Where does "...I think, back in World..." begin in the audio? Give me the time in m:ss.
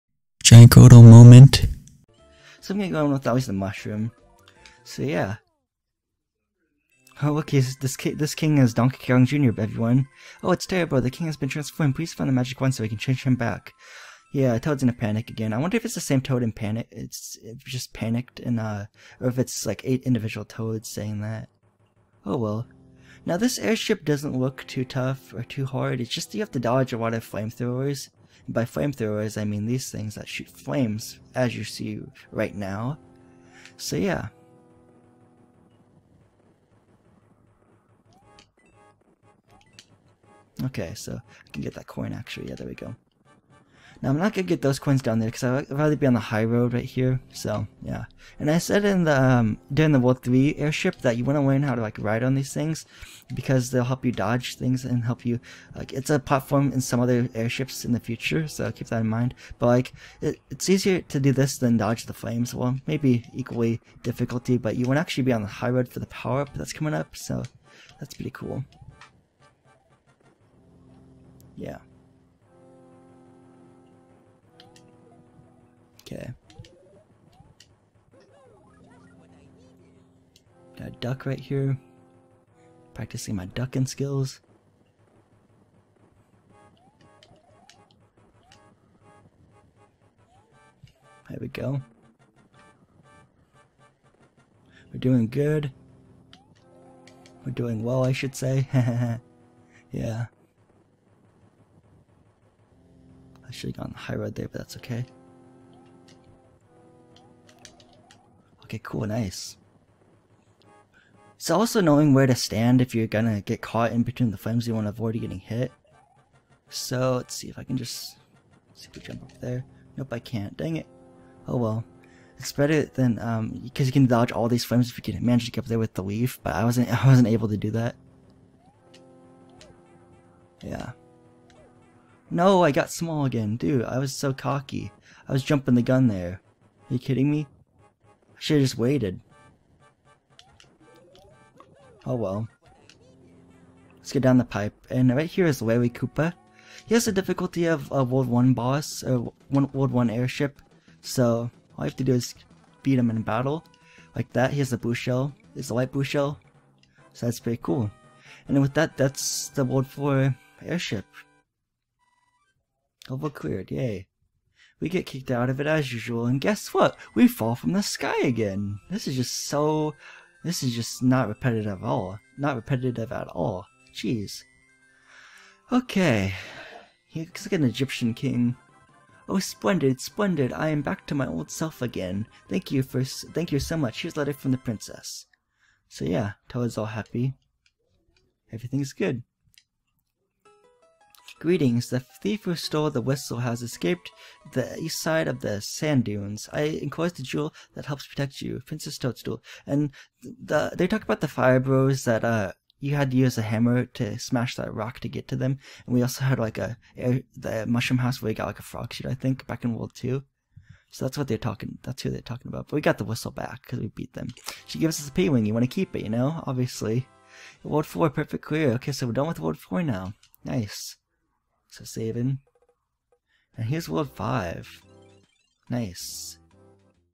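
3:29.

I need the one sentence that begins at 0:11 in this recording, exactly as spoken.
Please find the magic one so we can change him back.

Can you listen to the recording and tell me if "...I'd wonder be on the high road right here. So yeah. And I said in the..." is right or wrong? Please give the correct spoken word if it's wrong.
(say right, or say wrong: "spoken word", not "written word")
wrong: "rather", not "wonder".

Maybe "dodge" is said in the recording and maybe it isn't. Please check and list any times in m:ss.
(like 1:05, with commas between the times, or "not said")
0:26, 0:54, 1:01, 2:04.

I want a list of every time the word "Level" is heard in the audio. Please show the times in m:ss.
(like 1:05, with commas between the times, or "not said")
2:43.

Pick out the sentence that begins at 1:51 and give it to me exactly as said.
So, also knowing where to stand if you're gonna get caught in between the flames you want to avoid getting hit.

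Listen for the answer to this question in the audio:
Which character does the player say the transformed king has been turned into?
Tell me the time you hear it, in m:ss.
0:08.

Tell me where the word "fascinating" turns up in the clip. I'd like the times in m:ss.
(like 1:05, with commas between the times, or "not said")
not said.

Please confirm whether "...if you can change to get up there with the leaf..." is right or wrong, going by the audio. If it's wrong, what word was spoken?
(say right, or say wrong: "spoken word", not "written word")
wrong: "manage", not "change".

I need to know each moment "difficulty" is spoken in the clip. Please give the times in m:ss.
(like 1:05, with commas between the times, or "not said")
1:04, 2:27.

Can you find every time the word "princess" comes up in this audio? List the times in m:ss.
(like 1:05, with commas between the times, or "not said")
3:04, 3:18.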